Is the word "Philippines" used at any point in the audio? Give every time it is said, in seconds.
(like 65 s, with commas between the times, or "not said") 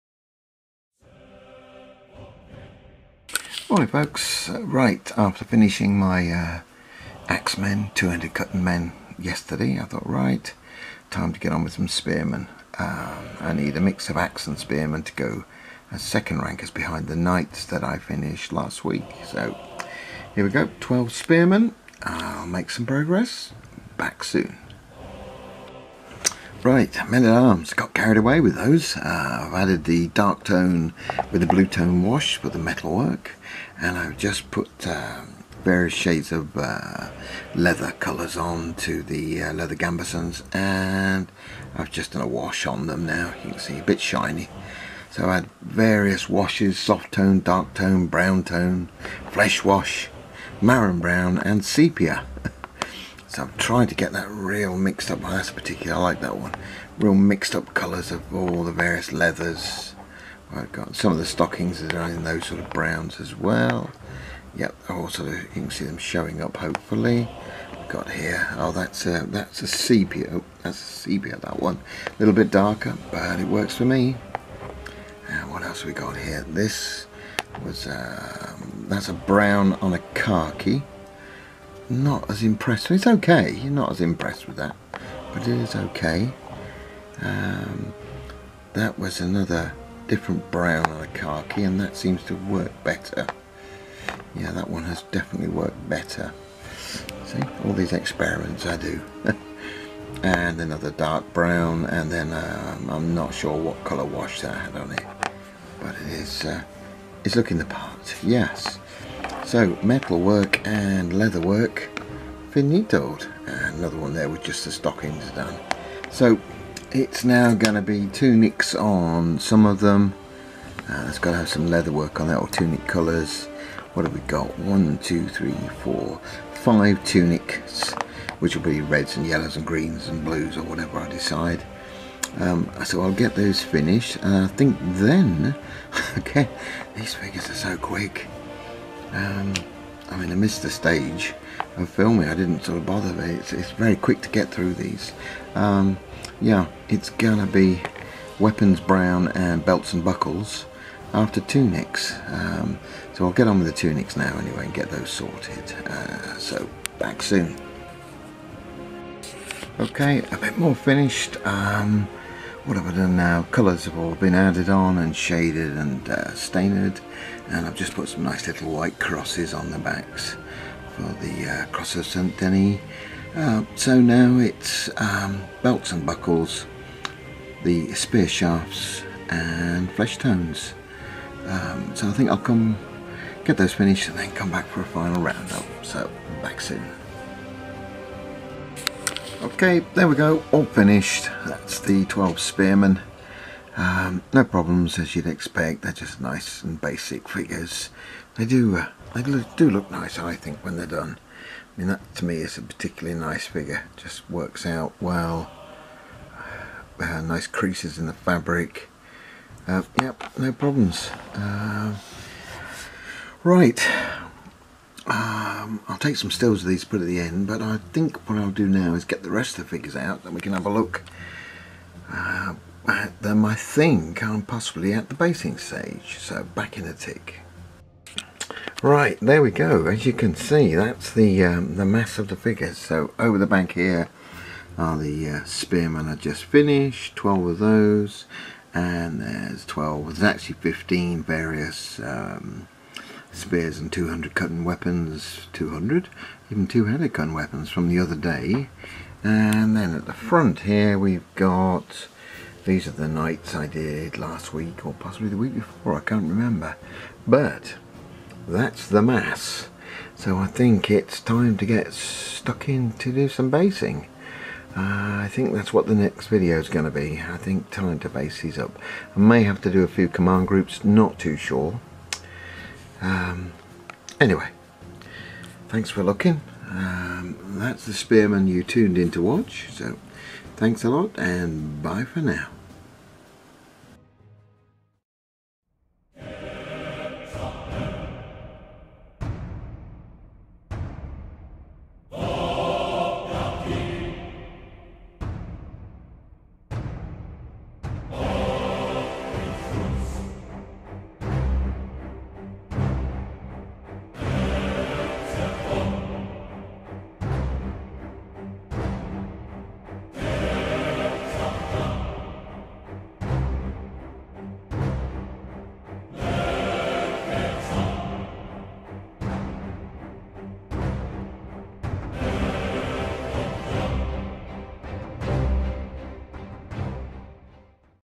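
not said.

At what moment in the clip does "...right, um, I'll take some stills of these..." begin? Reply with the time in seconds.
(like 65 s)
213 s.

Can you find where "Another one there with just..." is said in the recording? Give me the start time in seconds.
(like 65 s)
113 s.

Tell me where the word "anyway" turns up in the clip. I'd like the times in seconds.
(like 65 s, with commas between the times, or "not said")
154 s, 274 s.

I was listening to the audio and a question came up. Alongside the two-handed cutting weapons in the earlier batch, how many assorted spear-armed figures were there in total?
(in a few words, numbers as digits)
15.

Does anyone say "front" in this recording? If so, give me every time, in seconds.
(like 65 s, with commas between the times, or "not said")
250 s.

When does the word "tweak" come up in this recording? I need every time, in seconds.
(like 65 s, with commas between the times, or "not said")
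not said.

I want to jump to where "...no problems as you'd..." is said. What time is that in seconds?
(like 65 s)
194 s.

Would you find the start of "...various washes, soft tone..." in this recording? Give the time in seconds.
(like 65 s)
45 s.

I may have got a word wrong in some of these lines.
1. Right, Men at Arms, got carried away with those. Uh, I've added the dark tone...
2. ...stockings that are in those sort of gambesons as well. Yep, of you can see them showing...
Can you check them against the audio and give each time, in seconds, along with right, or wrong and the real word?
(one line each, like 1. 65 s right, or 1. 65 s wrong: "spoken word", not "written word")
1. 26 s right
2. 61 s wrong: "browns", not "gambesons".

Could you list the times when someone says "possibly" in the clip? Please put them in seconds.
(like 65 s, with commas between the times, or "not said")
224 s, 254 s.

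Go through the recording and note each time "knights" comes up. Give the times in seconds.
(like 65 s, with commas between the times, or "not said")
17 s, 253 s.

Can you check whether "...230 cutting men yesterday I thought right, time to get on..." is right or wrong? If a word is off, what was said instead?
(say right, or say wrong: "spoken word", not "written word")
wrong: "200", not "230".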